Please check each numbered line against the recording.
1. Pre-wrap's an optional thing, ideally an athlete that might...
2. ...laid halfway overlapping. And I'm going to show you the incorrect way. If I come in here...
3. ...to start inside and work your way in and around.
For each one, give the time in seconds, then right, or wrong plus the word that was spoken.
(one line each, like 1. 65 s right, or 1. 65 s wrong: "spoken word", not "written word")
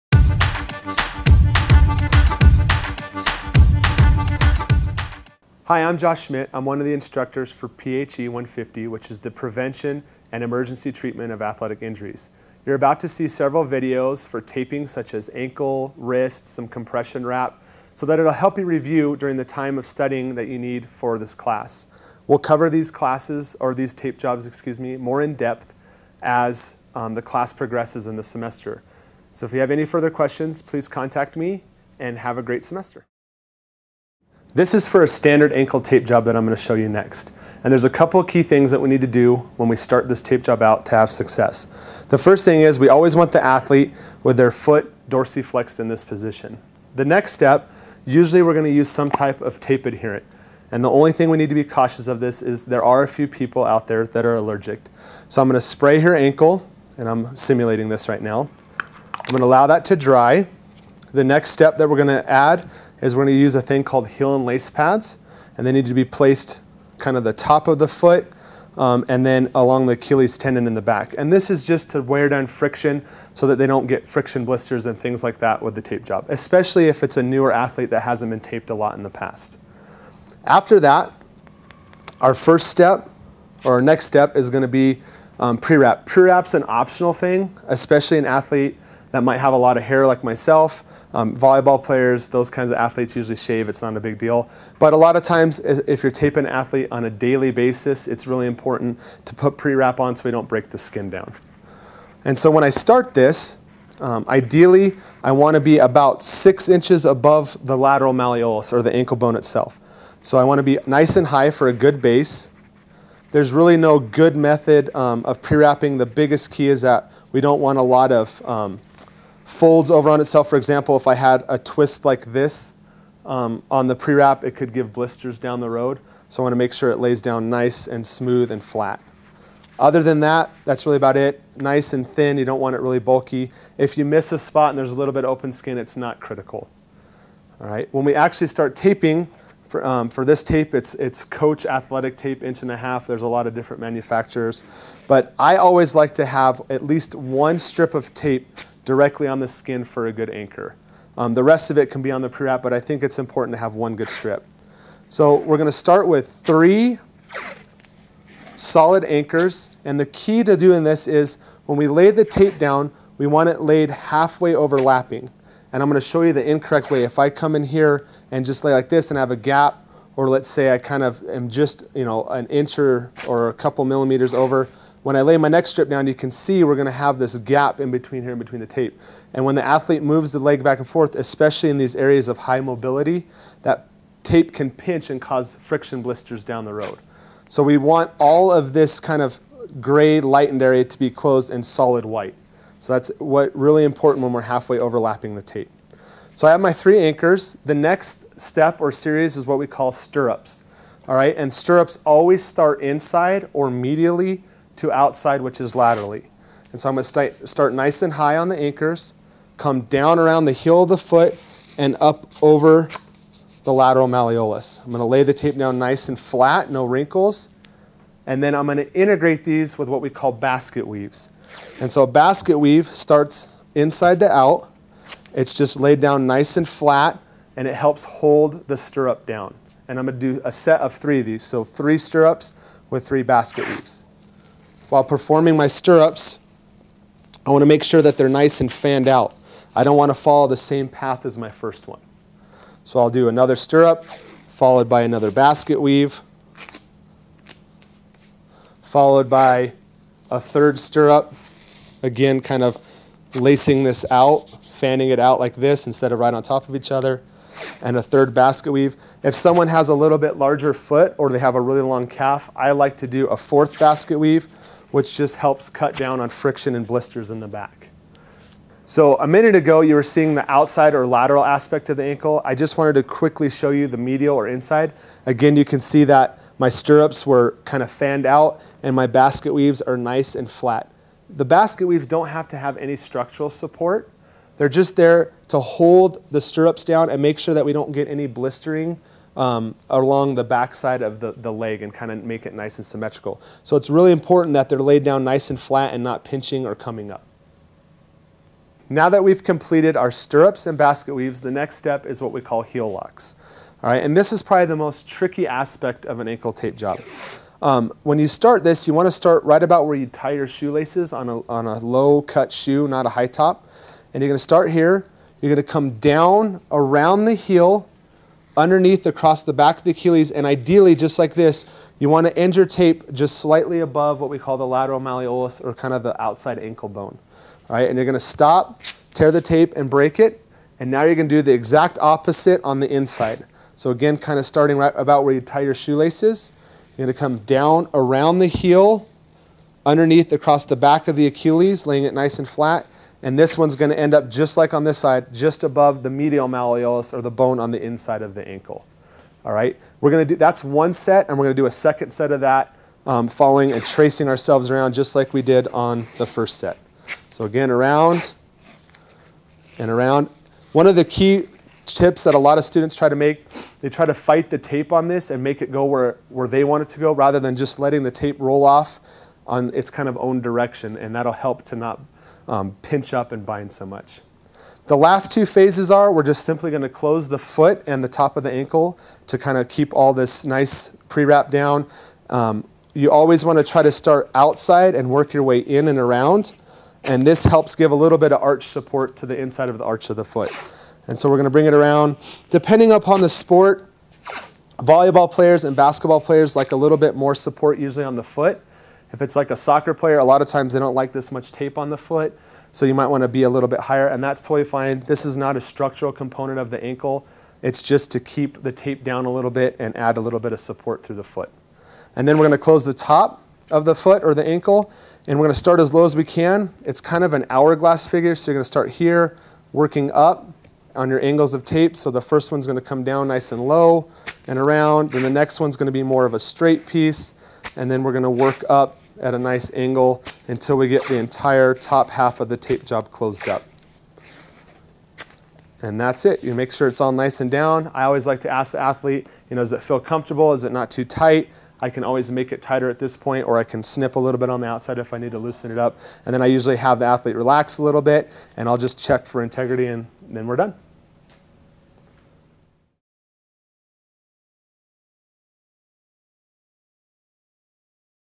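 1. 86 s wrong: "especially", not "ideally"
2. 163 s right
3. 383 s wrong: "outside", not "inside".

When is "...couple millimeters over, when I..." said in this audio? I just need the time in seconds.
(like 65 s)
173 s.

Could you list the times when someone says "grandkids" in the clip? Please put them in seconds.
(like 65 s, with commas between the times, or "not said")
not said.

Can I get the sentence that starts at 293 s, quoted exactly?
So it's really important that they're laid down nice and flat and not pinching or coming up.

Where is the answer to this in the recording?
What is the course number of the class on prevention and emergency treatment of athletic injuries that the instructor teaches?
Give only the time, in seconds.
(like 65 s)
7 s.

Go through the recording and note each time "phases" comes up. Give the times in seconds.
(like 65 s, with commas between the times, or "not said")
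375 s.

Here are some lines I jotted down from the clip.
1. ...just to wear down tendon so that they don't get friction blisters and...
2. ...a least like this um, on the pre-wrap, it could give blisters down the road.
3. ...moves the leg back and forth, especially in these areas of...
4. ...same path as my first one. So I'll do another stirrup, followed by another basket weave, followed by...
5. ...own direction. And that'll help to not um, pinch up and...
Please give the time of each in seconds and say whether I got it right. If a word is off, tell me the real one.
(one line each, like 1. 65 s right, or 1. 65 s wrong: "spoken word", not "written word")
1. 71 s wrong: "friction", not "tendon"
2. 121 s wrong: "twist", not "least"
3. 180 s right
4. 240 s right
5. 370 s right.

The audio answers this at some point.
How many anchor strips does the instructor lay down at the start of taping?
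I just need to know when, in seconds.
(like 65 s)
156 s.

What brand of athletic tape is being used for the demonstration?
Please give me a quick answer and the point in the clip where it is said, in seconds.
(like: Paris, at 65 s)
Coach, at 141 s.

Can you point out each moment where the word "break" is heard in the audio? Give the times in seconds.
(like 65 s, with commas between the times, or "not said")
100 s, 329 s.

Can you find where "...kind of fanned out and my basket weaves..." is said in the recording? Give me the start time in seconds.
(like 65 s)
277 s.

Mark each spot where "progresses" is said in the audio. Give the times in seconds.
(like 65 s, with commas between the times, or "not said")
27 s.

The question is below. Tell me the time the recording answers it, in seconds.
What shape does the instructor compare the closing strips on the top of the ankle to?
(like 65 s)
417 s.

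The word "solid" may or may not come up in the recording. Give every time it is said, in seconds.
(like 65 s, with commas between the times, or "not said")
158 s, 191 s.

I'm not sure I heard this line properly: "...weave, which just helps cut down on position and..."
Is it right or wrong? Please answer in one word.
wrong.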